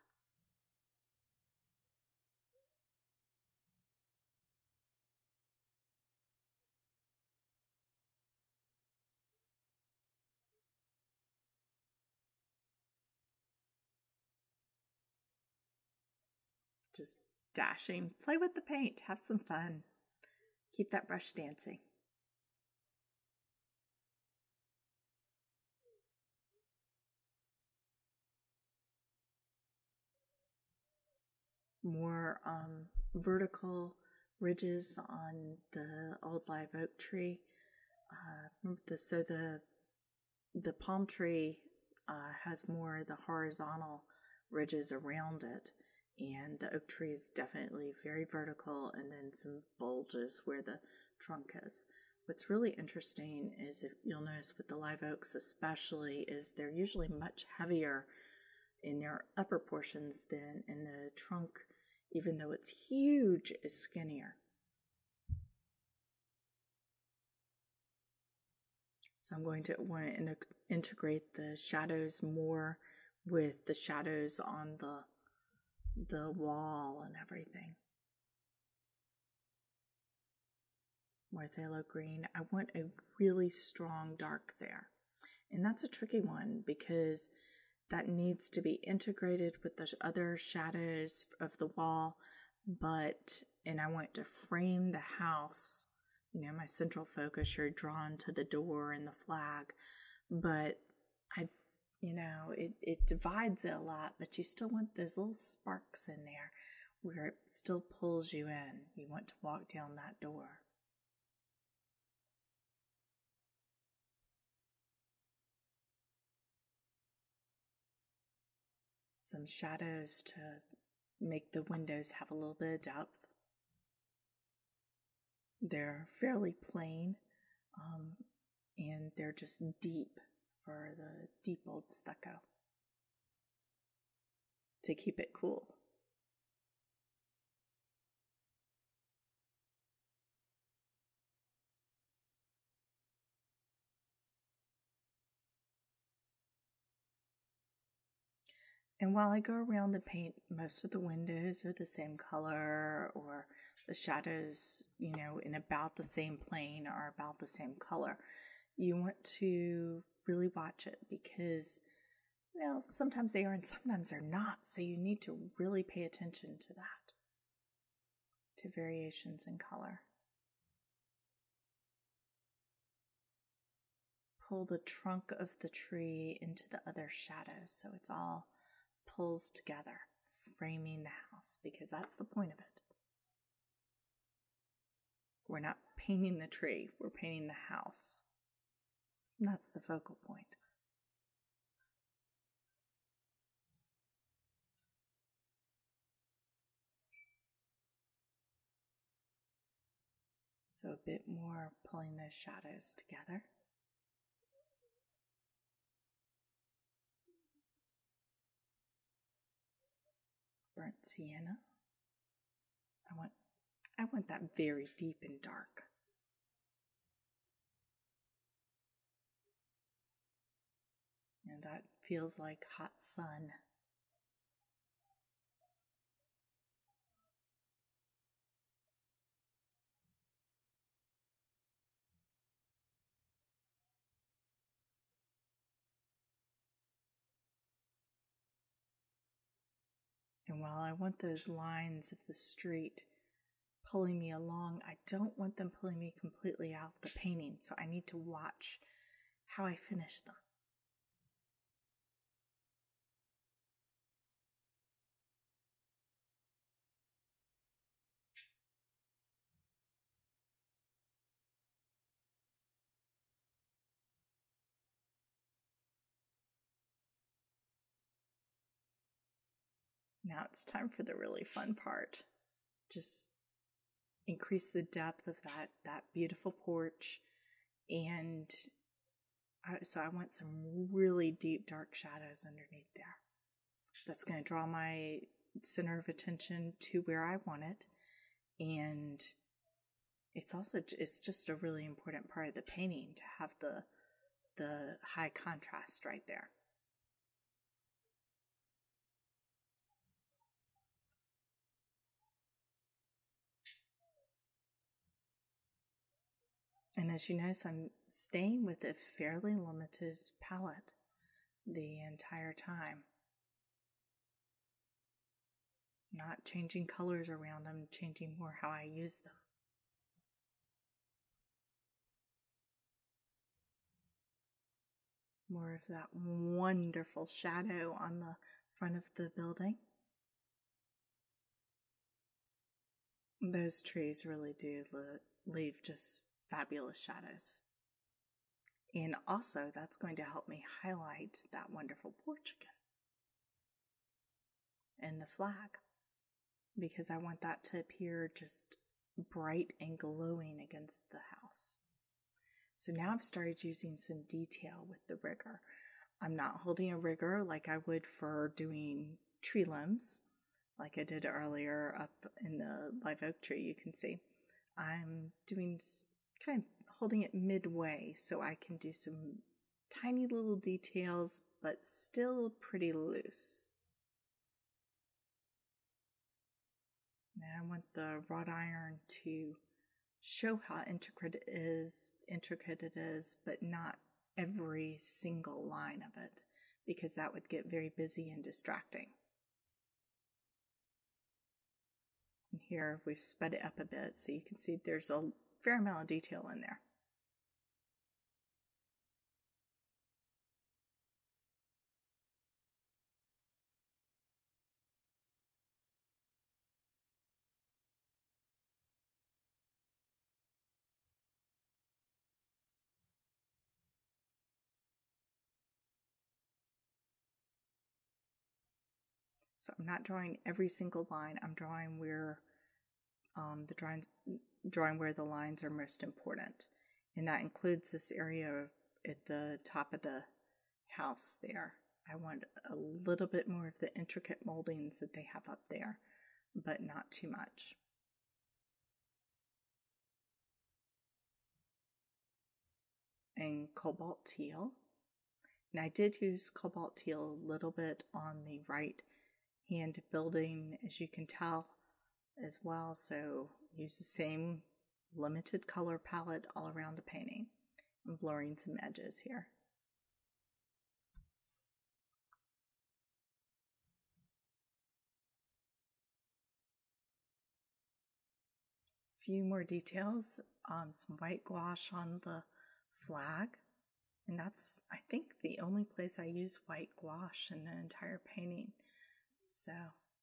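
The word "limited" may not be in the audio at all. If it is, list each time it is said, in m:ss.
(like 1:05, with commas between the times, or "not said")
5:09, 7:35.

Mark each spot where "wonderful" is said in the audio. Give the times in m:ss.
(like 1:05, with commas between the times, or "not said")
5:26, 5:41.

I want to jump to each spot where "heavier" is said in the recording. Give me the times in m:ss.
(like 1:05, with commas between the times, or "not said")
0:57.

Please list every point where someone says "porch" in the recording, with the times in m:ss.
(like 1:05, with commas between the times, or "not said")
4:36, 5:42.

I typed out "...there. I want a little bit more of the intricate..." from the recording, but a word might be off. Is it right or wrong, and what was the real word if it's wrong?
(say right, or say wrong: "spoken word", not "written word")
right.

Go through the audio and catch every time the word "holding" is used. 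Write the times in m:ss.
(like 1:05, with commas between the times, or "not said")
5:56, 6:06.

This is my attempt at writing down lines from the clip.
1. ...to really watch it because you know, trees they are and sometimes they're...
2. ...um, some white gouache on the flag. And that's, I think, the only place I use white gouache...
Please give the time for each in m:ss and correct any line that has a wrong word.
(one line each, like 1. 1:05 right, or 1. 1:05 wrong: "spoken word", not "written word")
1. 2:39 wrong: "sometimes", not "trees"
2. 7:50 right.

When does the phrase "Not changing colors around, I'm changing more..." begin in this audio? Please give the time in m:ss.
5:16.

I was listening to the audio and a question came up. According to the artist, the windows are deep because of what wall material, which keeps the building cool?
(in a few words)
Stucco.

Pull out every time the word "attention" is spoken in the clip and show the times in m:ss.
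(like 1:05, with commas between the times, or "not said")
2:46, 4:46.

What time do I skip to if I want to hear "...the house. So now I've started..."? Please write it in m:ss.
5:51.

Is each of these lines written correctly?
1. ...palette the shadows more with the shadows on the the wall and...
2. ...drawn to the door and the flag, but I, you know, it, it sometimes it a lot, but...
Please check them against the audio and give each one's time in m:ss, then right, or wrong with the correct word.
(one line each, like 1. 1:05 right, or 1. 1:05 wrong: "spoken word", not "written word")
1. 1:10 wrong: "integrate", not "palette"
2. 1:37 wrong: "divides", not "sometimes".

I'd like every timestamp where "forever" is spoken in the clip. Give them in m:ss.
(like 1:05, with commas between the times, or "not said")
not said.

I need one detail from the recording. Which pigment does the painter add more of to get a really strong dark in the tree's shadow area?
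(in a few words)
Phthalo green.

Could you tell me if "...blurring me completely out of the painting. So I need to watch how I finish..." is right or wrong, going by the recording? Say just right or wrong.
wrong.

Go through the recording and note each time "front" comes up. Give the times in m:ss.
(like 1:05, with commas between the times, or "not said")
5:28.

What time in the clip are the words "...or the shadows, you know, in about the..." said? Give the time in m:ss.
2:33.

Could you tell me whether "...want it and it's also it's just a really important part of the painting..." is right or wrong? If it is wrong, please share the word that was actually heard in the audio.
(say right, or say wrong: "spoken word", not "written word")
right.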